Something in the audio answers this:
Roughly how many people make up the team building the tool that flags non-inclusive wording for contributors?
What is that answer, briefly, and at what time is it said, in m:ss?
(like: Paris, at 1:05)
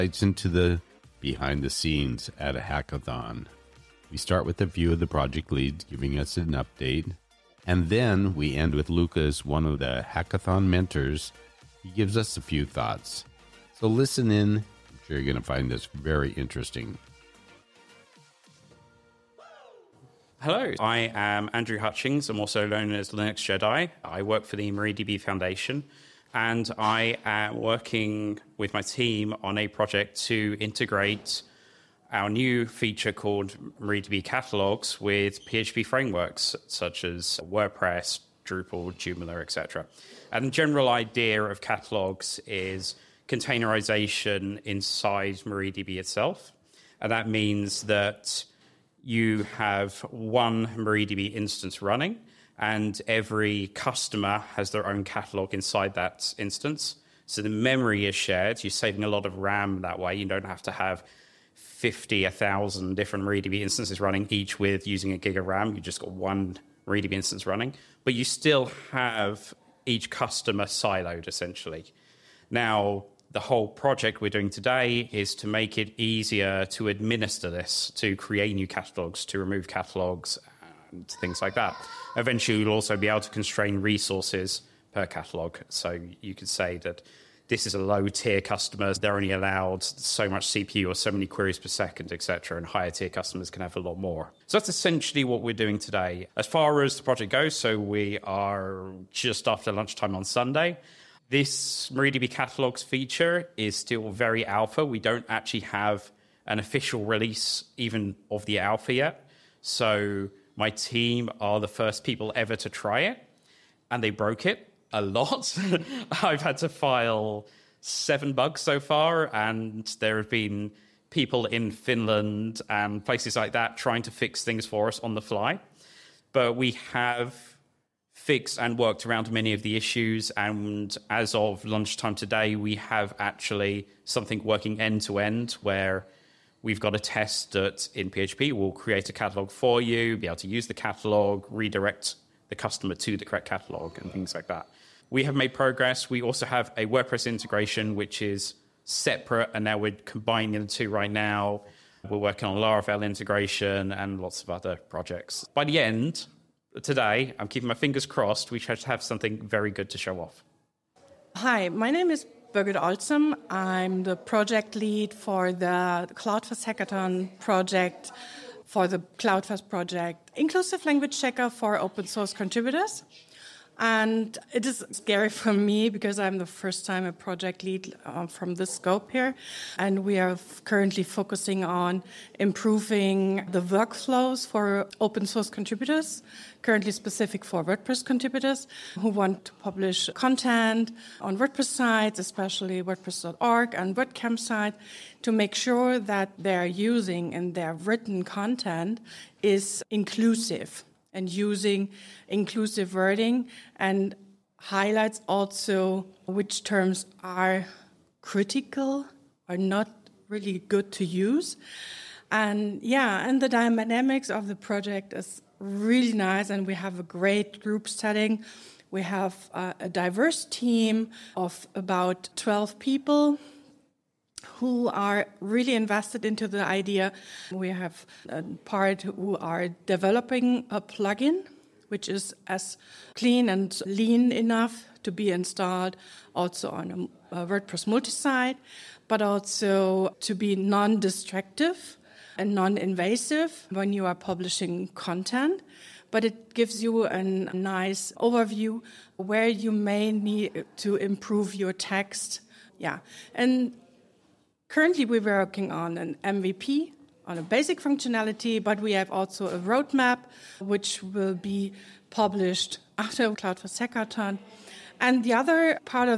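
12, at 3:42.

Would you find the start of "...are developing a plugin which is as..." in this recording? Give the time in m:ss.
3:49.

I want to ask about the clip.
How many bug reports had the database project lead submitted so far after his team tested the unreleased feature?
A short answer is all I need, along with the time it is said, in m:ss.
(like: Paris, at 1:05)
7, at 1:57.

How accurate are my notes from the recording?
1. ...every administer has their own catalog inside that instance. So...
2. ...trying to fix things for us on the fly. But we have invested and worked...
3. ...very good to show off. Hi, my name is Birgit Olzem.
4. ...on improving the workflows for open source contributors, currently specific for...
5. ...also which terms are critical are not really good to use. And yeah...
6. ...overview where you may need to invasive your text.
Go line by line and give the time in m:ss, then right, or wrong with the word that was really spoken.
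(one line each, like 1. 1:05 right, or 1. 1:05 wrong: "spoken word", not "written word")
1. 0:53 wrong: "customer", not "administer"
2. 2:03 wrong: "fixed", not "invested"
3. 2:39 right
4. 3:01 right
5. 3:25 right
6. 4:08 wrong: "improve", not "invasive".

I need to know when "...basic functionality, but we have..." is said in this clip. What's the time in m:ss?
4:17.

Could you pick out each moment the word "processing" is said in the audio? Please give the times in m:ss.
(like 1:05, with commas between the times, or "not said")
not said.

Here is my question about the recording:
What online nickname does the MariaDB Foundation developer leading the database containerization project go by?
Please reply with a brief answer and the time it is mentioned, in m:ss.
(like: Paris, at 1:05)
Linux Jedi, at 0:23.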